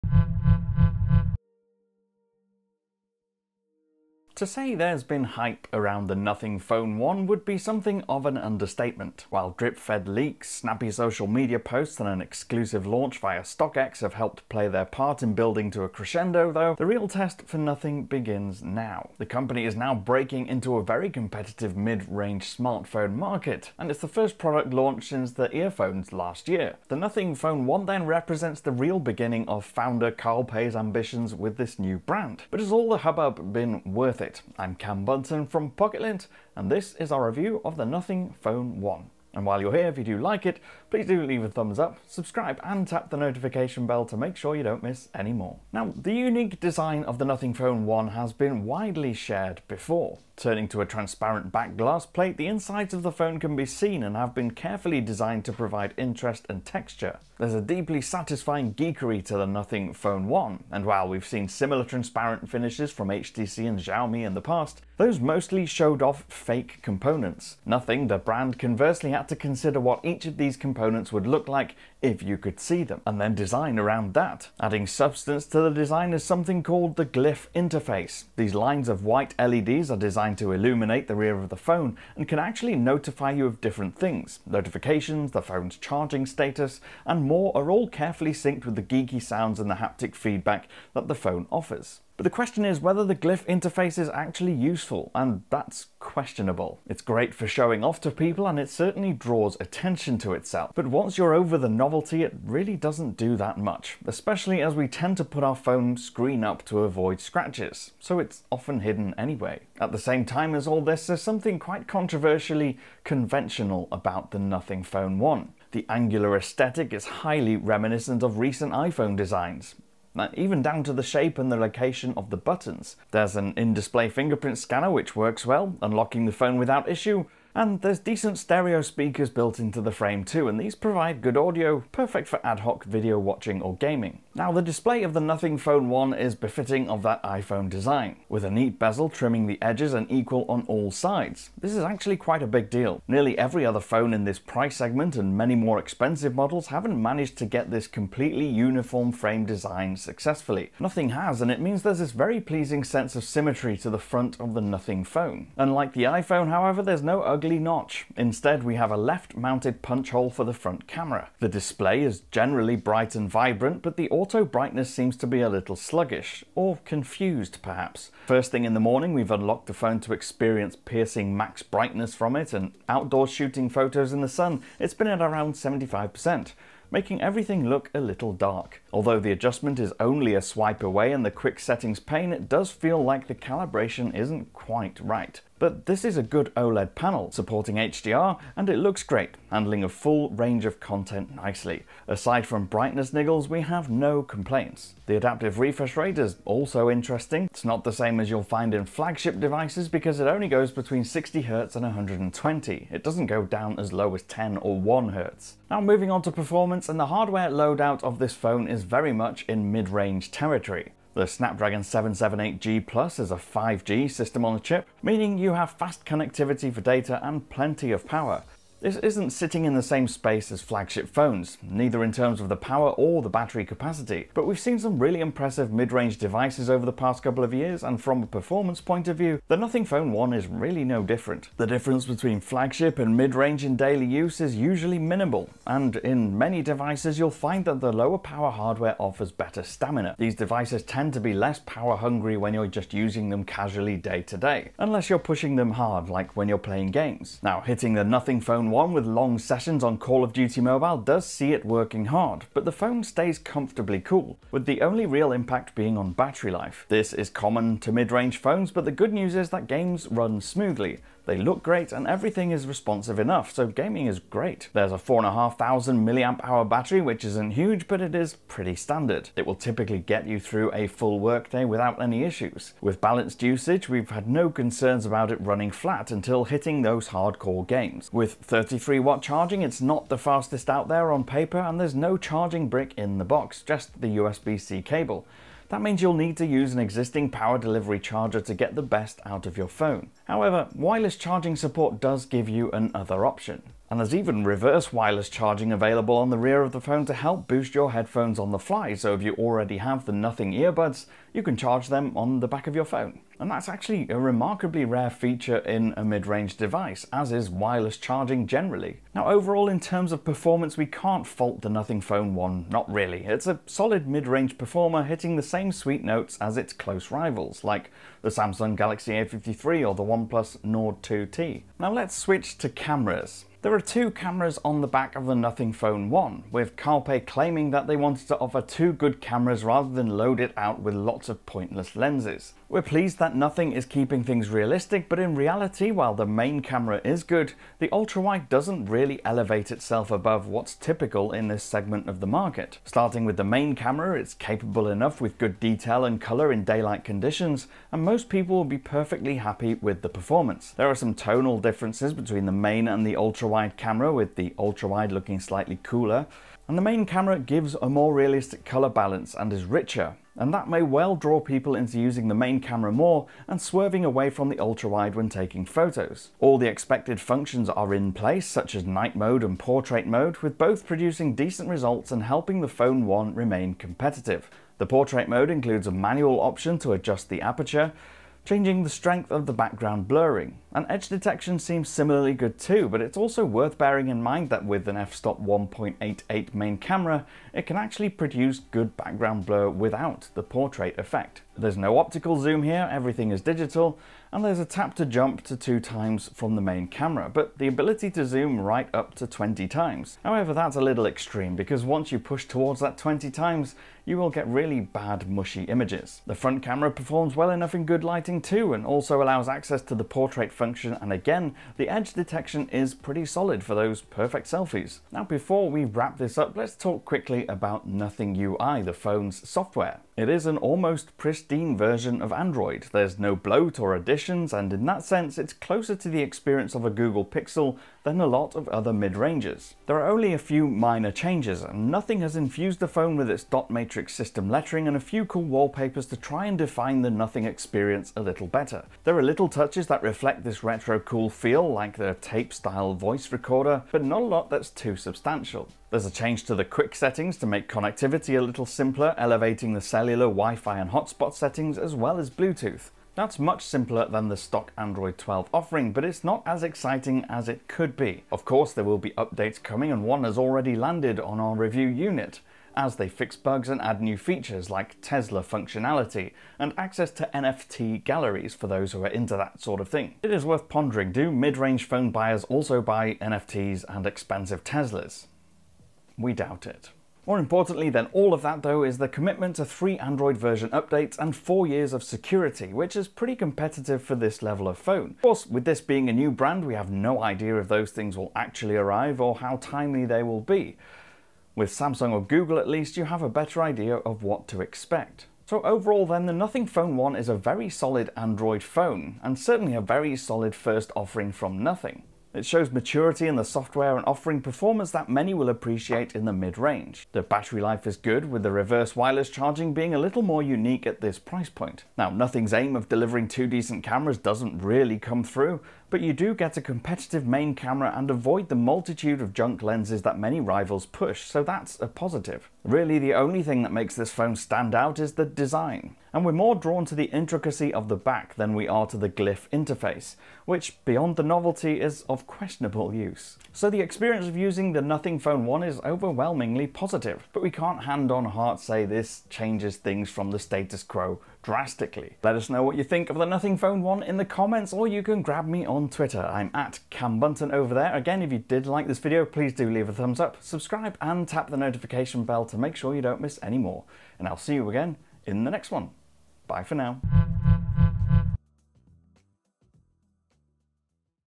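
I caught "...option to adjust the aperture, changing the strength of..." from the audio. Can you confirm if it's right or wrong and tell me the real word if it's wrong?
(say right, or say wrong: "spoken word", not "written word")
right.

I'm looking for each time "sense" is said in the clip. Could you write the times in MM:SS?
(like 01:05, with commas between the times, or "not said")
02:32, 07:05.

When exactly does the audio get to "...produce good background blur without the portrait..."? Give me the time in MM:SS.
06:28.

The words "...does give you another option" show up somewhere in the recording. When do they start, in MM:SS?
04:52.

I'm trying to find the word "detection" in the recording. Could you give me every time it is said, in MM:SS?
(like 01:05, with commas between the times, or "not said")
06:21, 06:52.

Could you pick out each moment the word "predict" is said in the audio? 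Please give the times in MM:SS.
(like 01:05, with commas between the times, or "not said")
not said.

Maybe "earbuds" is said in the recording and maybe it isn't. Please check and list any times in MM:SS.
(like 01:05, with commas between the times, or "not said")
05:00.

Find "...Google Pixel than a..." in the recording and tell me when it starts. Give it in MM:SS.
07:06.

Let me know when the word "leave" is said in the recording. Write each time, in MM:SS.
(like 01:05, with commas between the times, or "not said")
00:41, 09:09.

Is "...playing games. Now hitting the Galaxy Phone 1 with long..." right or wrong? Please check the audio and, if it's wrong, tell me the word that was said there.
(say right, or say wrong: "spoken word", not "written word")
wrong: "Nothing", not "Galaxy".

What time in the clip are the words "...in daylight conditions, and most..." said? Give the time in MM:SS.
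05:46.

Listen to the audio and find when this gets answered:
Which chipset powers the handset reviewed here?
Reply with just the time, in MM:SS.
03:31.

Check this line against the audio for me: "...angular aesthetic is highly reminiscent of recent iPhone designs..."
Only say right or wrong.
right.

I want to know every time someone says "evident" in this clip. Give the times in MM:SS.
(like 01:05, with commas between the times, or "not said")
not said.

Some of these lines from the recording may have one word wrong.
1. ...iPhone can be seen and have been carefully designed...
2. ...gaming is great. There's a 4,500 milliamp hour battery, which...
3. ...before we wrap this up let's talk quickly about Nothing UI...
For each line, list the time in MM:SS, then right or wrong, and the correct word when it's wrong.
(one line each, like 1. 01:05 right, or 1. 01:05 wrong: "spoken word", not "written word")
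1. 00:53 wrong: "phone", not "iPhone"
2. 04:23 right
3. 06:55 right.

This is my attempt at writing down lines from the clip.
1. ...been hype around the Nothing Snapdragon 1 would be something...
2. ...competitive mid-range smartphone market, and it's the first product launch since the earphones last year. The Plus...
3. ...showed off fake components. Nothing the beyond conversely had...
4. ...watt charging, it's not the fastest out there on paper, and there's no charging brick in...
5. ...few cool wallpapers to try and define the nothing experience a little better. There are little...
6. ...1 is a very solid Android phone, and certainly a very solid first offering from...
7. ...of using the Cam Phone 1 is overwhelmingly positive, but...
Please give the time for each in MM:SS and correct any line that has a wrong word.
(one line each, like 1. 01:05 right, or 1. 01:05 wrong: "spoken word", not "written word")
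1. 00:05 wrong: "Phone", not "Snapdragon"
2. 00:21 wrong: "Nothing", not "Plus"
3. 01:05 wrong: "brand", not "beyond"
4. 04:38 right
5. 07:14 right
6. 08:16 right
7. 08:54 wrong: "Nothing", not "Cam".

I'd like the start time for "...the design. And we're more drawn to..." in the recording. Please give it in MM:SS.
08:45.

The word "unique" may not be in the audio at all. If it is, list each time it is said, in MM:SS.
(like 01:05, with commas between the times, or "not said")
00:46, 08:30.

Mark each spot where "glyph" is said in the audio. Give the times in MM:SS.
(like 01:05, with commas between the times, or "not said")
01:17, 01:33, 08:49.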